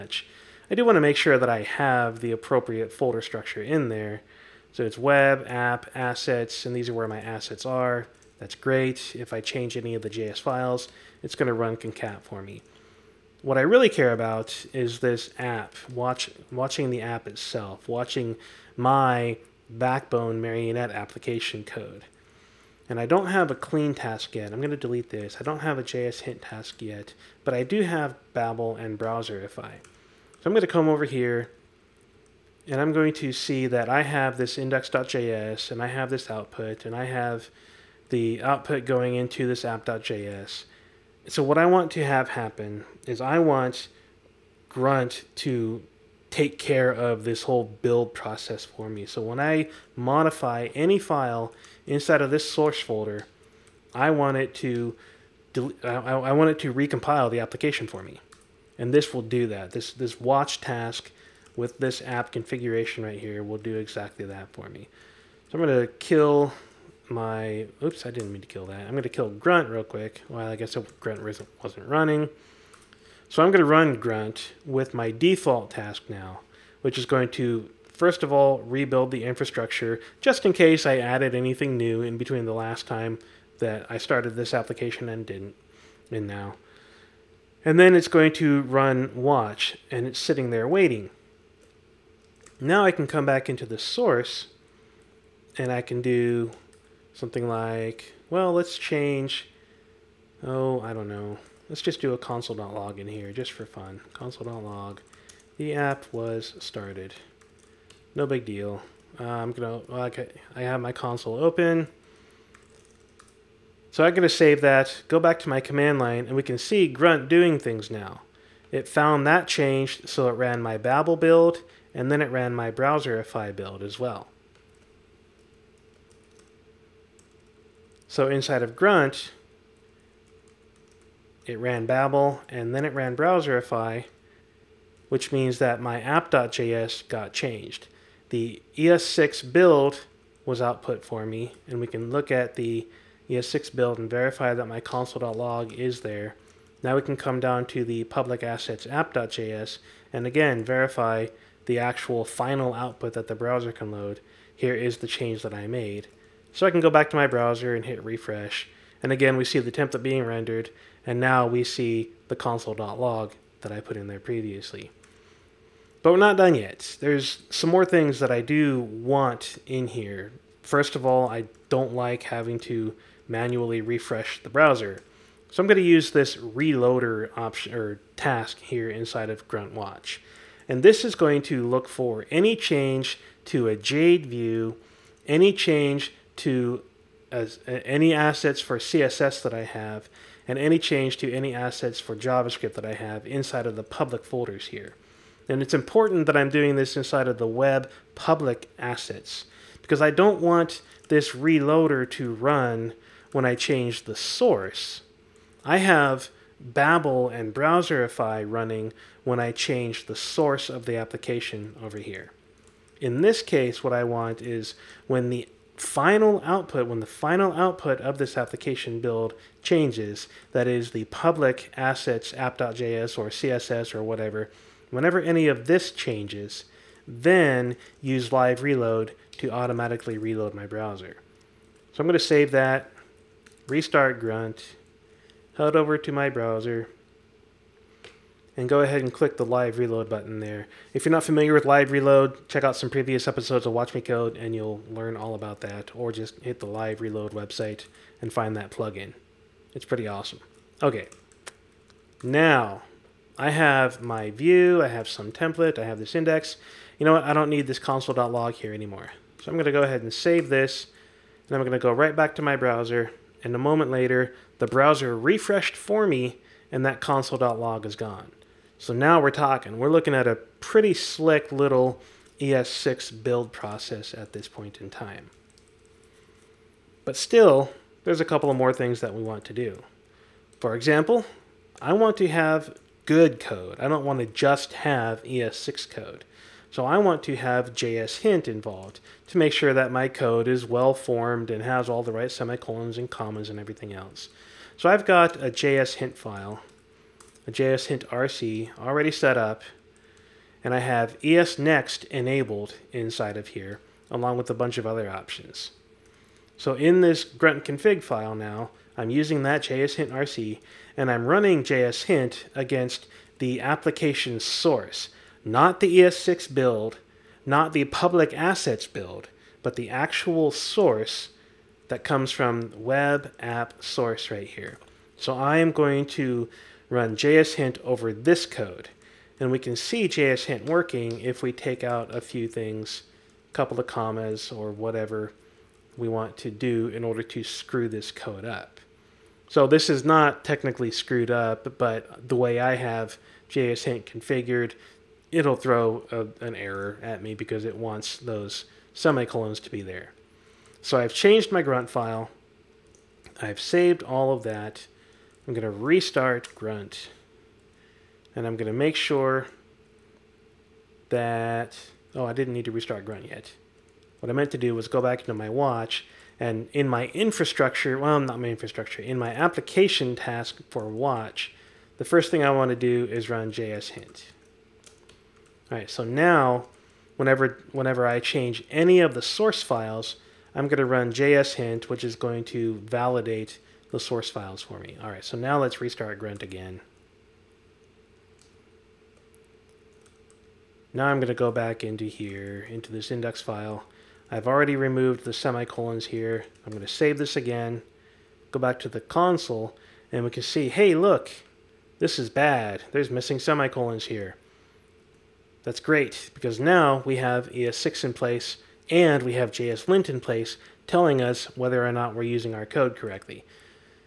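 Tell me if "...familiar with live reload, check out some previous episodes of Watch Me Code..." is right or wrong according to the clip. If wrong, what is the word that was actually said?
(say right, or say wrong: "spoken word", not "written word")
right.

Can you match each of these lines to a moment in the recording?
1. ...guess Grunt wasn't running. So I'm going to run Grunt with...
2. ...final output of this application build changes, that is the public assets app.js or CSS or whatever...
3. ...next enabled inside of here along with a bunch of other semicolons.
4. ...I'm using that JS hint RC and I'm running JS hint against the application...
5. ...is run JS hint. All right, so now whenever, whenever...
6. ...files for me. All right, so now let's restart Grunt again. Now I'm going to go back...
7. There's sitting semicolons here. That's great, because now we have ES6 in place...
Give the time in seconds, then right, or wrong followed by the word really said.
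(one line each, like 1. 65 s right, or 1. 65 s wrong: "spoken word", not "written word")
1. 70 s right
2. 217 s right
3. 301 s wrong: "options", not "semicolons"
4. 308 s right
5. 373 s right
6. 384 s right
7. 402 s wrong: "missing", not "sitting".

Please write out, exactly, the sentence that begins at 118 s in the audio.
It found that changed, so it ran my Babel build, and then it ran my Browserify build as well.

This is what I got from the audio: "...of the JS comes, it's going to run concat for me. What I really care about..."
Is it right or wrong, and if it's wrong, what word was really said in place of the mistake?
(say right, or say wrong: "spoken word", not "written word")
wrong: "files", not "comes".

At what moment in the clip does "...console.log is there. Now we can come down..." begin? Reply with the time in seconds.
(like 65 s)
144 s.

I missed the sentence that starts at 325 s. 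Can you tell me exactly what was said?
So I am going to run JS Hint over this code.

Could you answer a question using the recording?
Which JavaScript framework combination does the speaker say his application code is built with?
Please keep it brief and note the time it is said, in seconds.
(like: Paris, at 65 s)
Backbone Marionette, at 19 s.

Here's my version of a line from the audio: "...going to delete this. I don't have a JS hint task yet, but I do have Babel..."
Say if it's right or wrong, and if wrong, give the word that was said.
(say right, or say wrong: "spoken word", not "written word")
right.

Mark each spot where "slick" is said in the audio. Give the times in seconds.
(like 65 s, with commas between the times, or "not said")
270 s.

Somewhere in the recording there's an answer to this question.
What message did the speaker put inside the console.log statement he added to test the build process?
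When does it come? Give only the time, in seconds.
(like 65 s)
105 s.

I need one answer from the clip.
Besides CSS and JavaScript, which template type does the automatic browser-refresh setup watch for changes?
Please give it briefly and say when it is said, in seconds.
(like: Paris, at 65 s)
Jade, at 183 s.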